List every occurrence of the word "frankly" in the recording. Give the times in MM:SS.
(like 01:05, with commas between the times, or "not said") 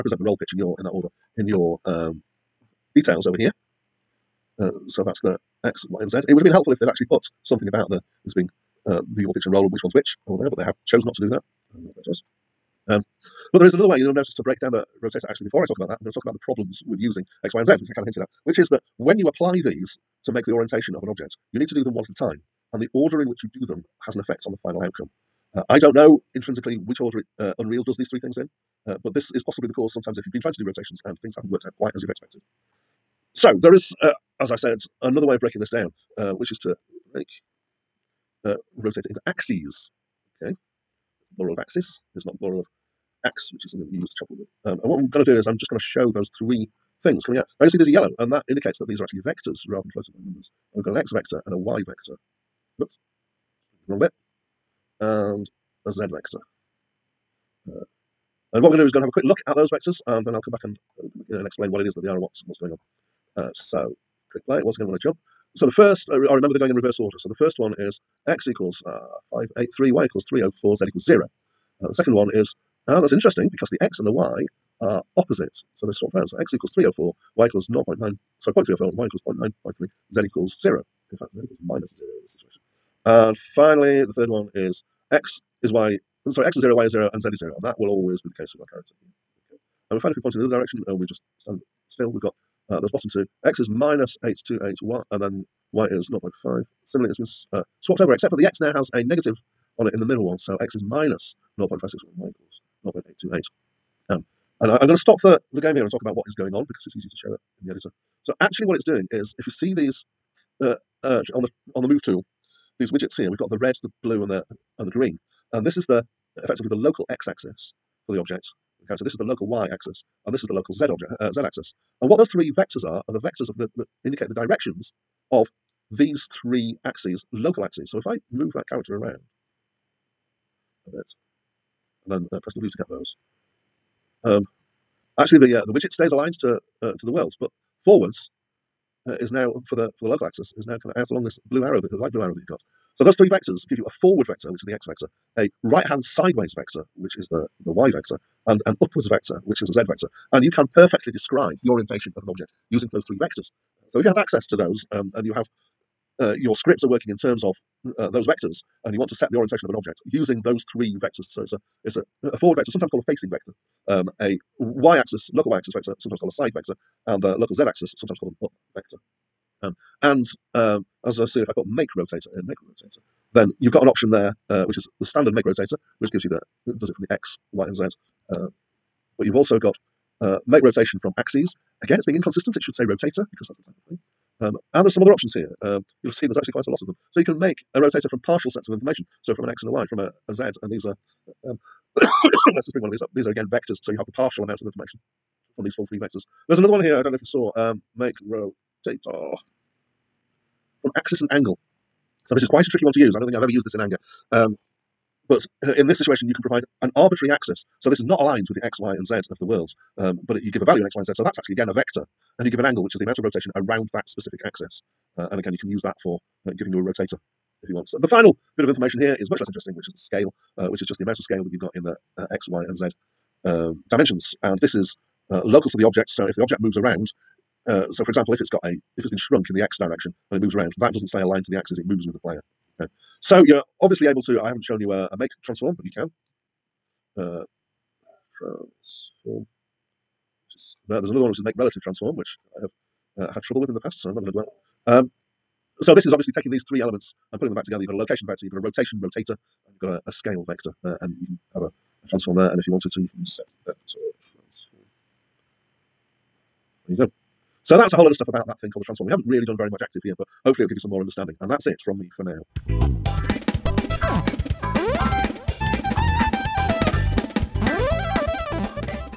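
not said.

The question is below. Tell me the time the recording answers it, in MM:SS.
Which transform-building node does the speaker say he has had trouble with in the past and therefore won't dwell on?
04:01.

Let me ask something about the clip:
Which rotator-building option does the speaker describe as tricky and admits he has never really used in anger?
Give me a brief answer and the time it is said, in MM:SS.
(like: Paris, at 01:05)
make rotate from axis and angle, at 03:17.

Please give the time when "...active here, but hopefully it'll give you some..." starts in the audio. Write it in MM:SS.
04:19.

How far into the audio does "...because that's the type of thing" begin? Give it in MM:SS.
03:03.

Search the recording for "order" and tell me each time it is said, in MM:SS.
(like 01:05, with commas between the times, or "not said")
00:00, 00:22, 00:27, 01:06.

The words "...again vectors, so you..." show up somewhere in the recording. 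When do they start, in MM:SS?
03:13.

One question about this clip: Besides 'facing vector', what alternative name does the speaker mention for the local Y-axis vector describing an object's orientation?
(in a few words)
side vector.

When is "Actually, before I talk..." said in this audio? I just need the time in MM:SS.
00:15.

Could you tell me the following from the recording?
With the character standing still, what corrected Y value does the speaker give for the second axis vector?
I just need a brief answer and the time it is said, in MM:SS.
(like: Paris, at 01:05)
0.953, at 01:19.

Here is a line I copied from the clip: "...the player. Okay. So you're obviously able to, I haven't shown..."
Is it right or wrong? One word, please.
right.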